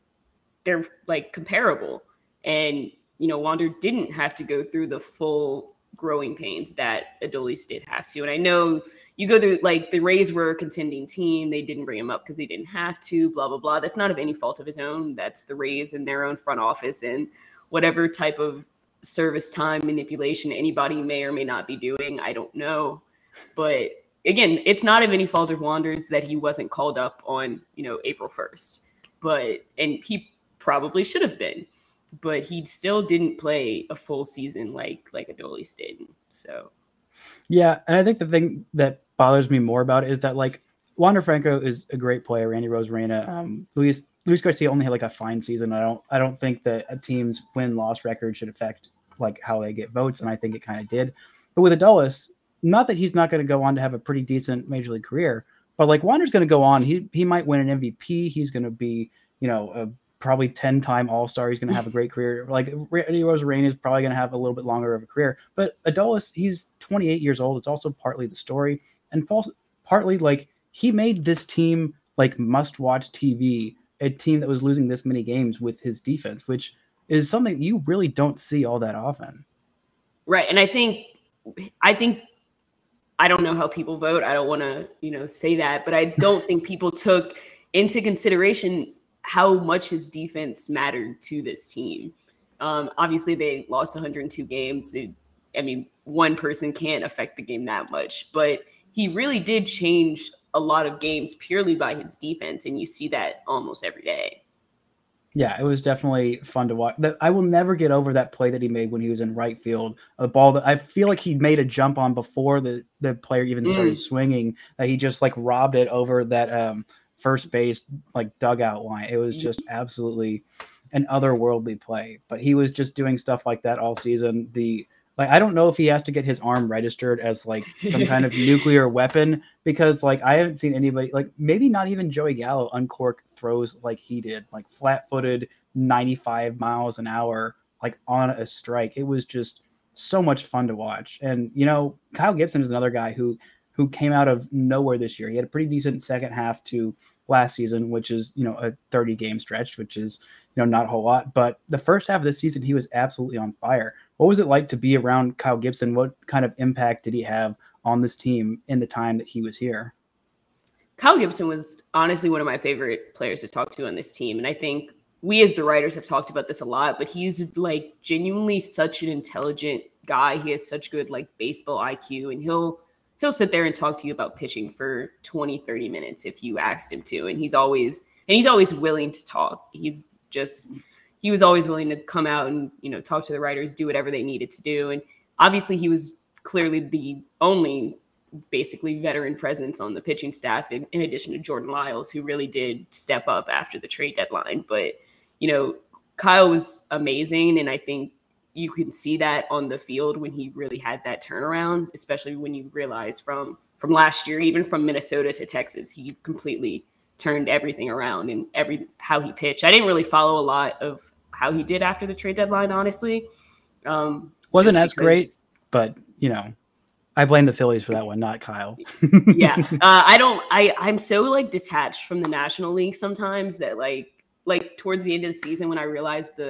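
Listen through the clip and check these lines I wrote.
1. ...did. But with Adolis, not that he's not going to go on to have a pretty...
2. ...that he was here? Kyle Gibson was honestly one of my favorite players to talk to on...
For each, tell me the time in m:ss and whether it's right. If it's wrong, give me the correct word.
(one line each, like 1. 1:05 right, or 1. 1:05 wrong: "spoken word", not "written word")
1. 0:50 right
2. 2:39 right.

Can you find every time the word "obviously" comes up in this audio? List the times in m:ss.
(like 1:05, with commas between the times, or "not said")
1:32, 3:05.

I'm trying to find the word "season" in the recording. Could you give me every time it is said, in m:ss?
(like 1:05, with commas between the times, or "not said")
0:34, 0:45, 2:03, 2:27, 2:32, 3:45.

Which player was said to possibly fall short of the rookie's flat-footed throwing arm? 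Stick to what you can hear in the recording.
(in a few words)
Joey Gallo.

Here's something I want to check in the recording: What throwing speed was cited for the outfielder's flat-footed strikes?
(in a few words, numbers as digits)
95 miles an hour.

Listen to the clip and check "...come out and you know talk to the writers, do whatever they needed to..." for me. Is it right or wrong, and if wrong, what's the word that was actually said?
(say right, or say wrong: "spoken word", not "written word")
right.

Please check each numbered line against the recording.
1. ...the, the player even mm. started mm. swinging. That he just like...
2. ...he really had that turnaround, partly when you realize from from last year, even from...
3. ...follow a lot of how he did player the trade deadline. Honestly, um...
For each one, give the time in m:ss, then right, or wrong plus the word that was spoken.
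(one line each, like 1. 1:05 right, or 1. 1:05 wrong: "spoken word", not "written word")
1. 1:52 right
2. 3:20 wrong: "especially", not "partly"
3. 3:30 wrong: "after", not "player".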